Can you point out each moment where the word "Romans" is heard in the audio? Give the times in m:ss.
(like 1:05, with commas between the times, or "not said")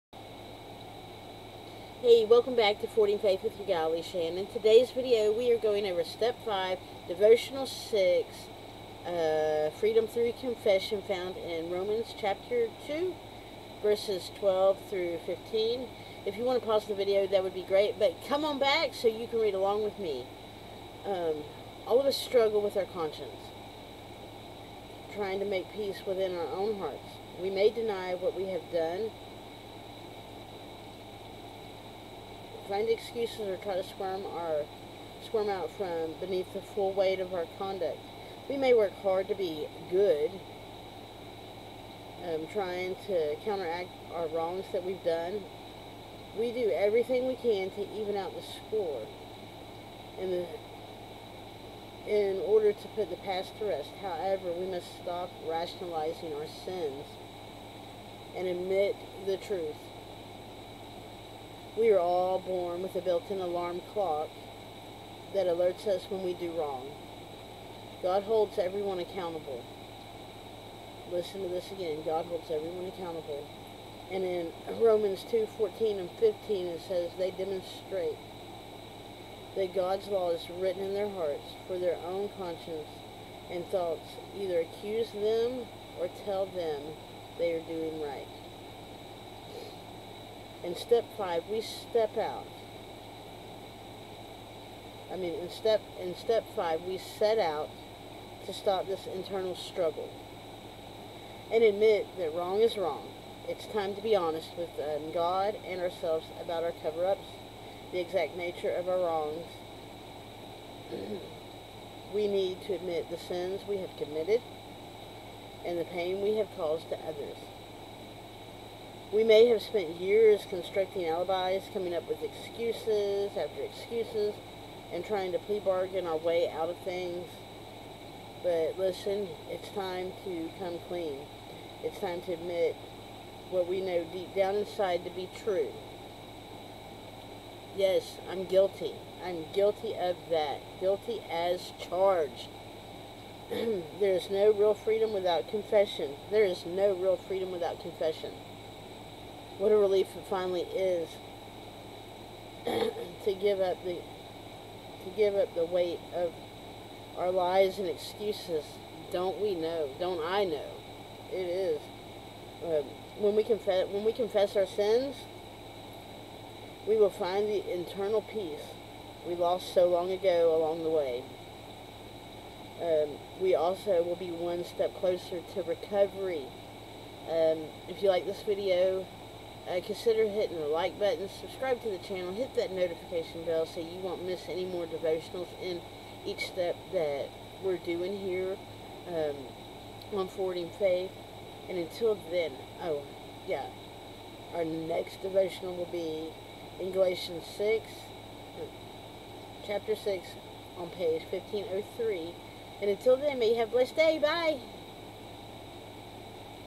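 0:11, 1:14.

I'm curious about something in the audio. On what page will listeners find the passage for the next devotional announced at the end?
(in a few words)
1503.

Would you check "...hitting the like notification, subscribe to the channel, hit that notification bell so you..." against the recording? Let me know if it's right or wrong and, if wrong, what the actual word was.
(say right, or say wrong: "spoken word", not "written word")
wrong: "button", not "notification".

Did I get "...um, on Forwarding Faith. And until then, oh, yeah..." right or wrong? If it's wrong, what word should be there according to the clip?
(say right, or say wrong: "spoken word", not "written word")
right.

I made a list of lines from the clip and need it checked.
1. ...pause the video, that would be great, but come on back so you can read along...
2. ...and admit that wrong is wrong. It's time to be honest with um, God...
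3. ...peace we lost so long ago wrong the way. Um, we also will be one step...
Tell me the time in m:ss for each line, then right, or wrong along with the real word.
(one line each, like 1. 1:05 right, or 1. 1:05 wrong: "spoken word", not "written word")
1. 0:16 right
2. 1:41 right
3. 2:48 wrong: "along", not "wrong".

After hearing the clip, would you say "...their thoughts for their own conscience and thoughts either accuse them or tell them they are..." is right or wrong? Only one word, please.
wrong.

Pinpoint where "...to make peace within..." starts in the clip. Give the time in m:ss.
0:25.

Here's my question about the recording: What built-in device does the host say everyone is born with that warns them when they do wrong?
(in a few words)
alarm clock.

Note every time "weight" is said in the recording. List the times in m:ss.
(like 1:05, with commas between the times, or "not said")
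0:36, 2:35.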